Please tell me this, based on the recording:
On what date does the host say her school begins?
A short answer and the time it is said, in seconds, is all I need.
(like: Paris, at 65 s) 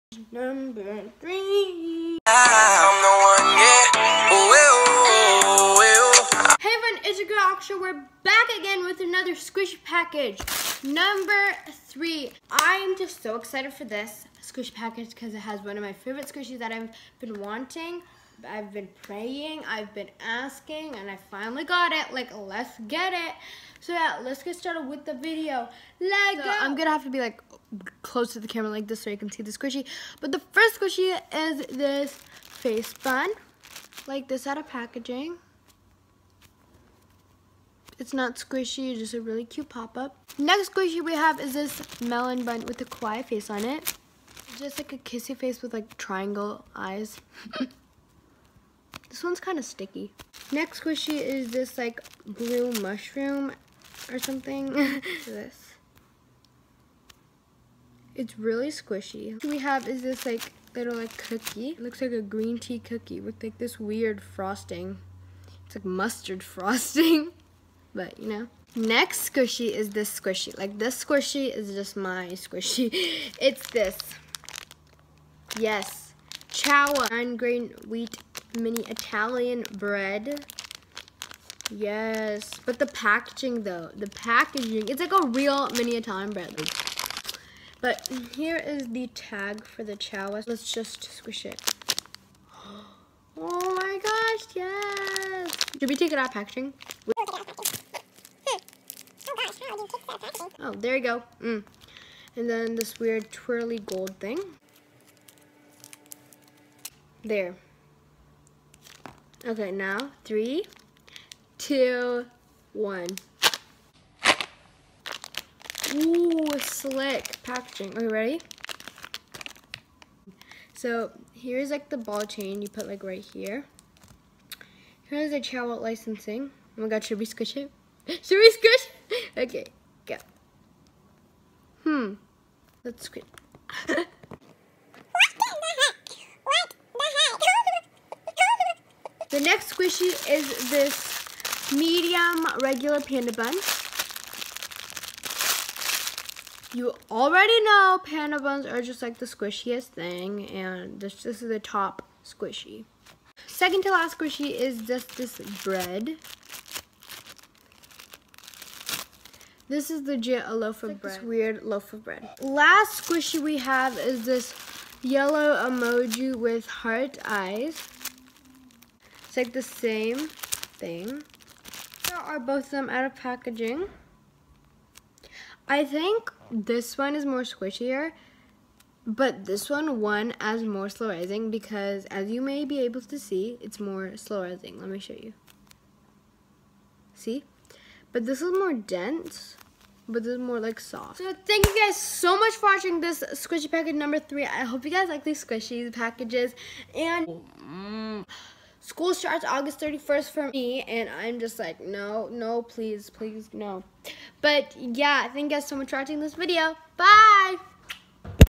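August 31st, at 199 s.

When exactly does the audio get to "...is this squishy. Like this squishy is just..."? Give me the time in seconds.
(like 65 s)
69 s.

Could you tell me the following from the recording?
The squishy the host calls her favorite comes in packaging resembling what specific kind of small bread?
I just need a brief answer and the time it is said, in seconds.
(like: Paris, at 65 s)
Nine grain wheat mini Italian bread, at 77 s.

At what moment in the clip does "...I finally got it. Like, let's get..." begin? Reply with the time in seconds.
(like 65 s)
21 s.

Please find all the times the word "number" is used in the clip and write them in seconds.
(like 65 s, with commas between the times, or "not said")
0 s, 10 s, 193 s.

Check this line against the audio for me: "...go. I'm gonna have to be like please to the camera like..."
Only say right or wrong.
wrong.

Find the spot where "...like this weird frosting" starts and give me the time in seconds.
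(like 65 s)
63 s.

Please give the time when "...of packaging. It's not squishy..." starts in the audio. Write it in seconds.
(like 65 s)
34 s.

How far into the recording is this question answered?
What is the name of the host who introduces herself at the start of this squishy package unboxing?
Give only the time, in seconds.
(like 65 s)
7 s.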